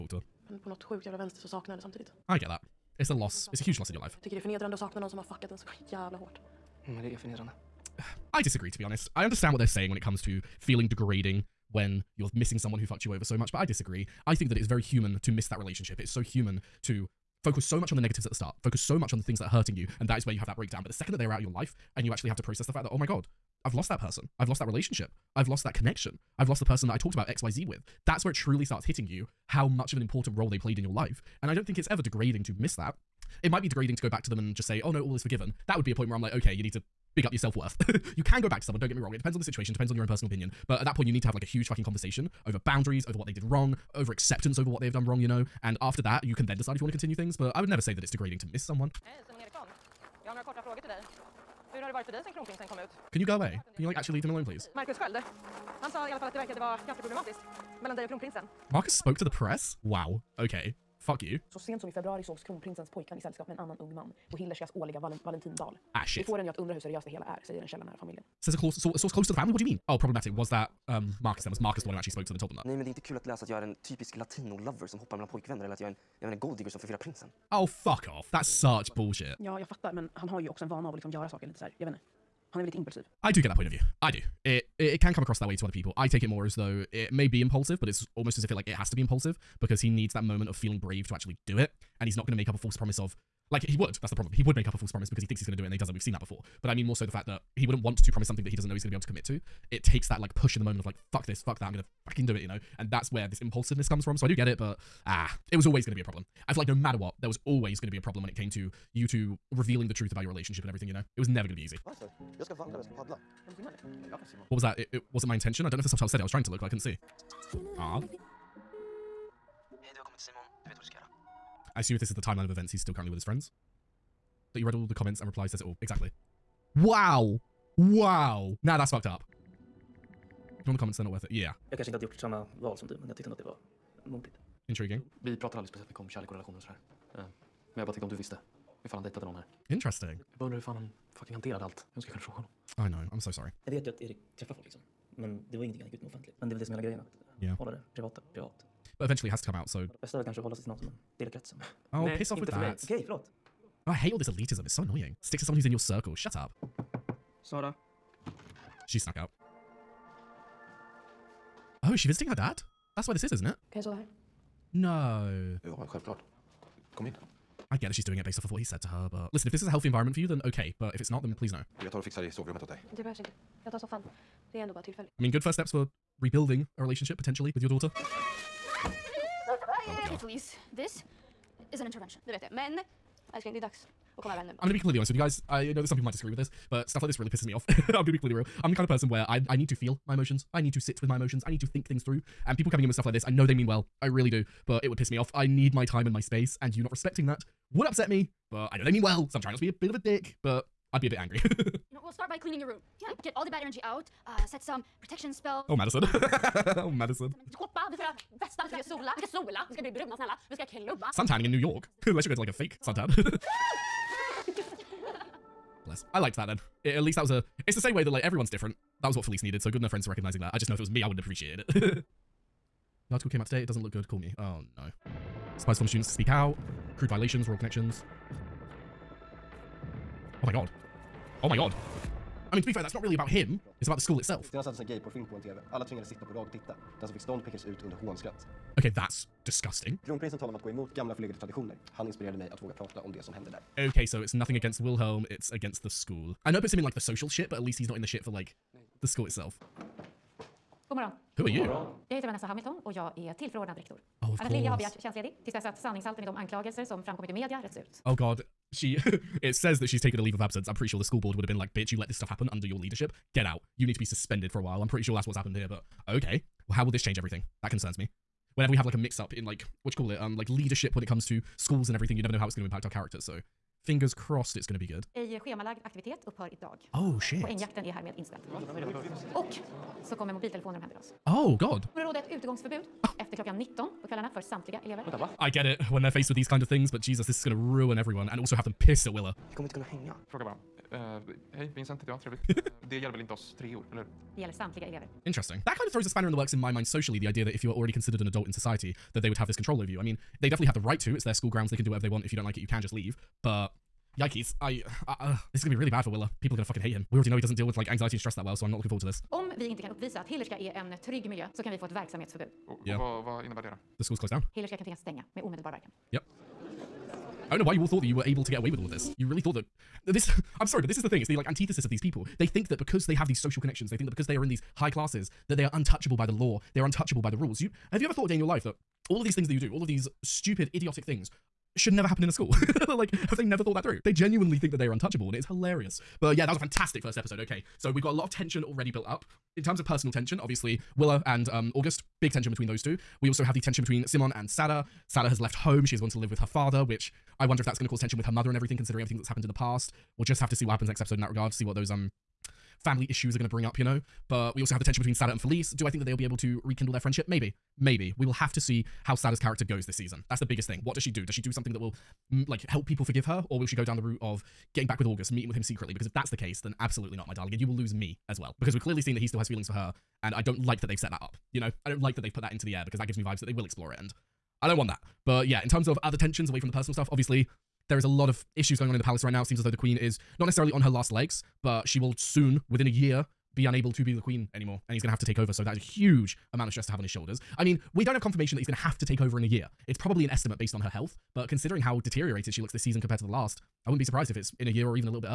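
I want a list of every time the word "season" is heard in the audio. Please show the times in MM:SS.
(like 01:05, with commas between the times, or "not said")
05:59, 06:32.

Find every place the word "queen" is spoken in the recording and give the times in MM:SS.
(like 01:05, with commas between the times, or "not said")
06:19, 06:24.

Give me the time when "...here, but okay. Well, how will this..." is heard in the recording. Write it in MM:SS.
04:25.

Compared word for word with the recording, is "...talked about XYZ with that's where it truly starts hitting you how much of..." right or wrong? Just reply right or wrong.
right.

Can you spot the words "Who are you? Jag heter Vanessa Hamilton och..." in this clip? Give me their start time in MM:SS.
04:11.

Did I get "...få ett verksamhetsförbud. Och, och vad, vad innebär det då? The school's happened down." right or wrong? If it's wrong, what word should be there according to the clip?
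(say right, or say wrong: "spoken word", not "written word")
wrong: "closed", not "happened".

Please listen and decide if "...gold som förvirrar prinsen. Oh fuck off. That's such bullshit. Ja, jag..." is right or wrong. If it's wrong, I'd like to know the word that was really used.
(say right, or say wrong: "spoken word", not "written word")
right.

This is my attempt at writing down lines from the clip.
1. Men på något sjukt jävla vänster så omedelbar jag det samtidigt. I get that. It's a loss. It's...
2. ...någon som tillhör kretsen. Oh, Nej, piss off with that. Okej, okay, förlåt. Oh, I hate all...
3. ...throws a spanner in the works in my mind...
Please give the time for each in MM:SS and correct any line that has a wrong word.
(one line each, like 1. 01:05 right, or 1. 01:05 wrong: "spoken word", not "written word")
1. 00:00 wrong: "saknar", not "omedelbar"
2. 02:30 right
3. 04:55 right.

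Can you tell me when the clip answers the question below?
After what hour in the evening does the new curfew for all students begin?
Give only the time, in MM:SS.
04:43.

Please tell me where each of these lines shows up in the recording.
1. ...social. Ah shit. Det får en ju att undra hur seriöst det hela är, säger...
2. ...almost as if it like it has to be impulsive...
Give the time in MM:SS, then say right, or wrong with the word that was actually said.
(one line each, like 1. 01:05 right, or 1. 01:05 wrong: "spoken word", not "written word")
1. 01:05 wrong: "valentinbal", not "social"
2. 01:28 right.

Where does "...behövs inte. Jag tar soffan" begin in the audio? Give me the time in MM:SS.
02:53.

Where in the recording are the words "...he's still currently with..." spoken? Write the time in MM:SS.
02:02.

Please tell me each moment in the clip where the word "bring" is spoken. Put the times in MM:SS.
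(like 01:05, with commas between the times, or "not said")
05:53.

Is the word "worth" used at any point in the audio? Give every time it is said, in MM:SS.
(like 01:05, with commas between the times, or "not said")
00:37, 02:11.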